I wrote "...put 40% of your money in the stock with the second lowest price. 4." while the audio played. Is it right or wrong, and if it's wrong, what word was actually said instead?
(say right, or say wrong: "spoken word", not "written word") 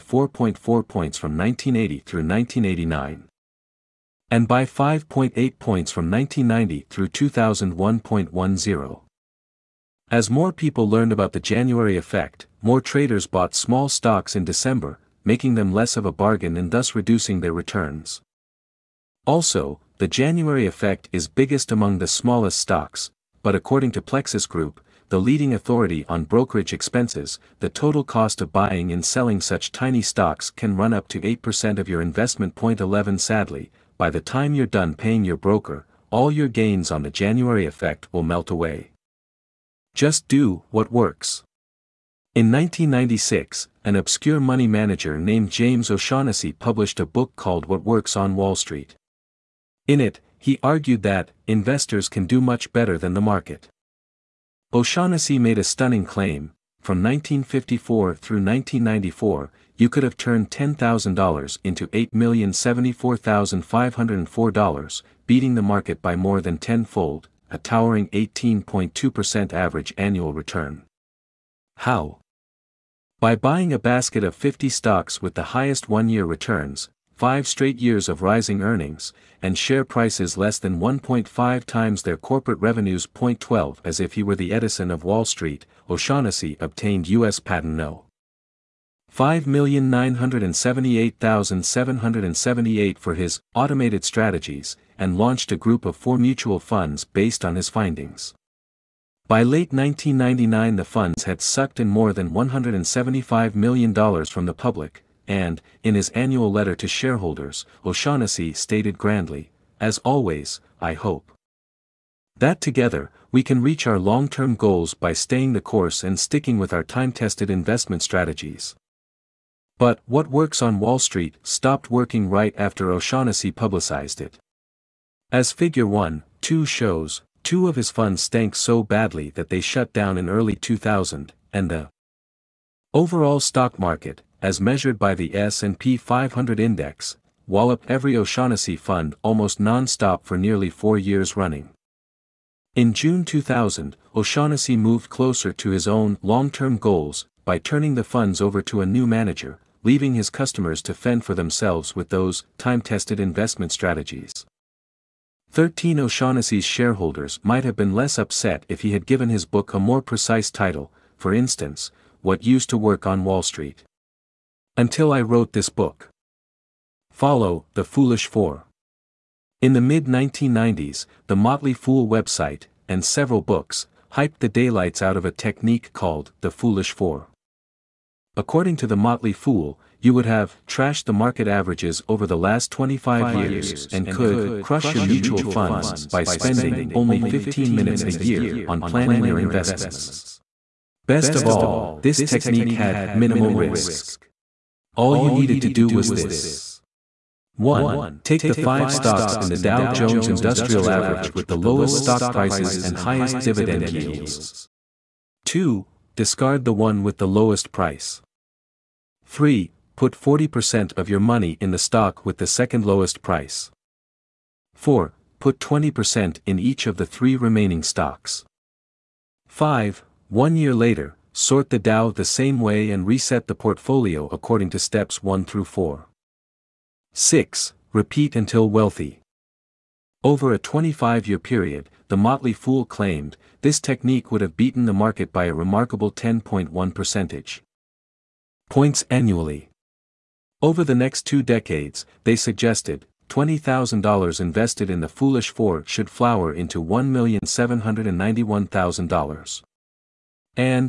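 right.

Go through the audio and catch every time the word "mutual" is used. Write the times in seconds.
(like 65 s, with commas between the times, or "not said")
96 s, 185 s.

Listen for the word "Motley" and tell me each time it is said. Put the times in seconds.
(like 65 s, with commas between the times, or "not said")
171 s, 178 s, 232 s.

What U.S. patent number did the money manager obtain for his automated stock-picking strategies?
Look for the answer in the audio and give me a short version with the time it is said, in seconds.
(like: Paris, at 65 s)
5,978,778, at 89 s.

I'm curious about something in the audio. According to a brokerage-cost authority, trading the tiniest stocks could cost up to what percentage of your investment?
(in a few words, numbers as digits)
8%.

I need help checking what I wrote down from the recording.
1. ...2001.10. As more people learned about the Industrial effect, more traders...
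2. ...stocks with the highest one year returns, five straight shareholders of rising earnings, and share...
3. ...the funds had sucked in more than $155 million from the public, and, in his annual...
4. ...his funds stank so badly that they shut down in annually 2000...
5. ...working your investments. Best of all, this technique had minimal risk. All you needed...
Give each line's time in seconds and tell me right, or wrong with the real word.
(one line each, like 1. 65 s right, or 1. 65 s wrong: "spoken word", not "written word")
1. 7 s wrong: "January", not "Industrial"
2. 74 s wrong: "years", not "shareholders"
3. 100 s wrong: "175", not "155"
4. 127 s wrong: "early", not "annually"
5. 188 s wrong: "planning", not "working".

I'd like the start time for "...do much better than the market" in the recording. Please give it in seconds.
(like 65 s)
52 s.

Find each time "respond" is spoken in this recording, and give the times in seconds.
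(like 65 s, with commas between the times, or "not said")
not said.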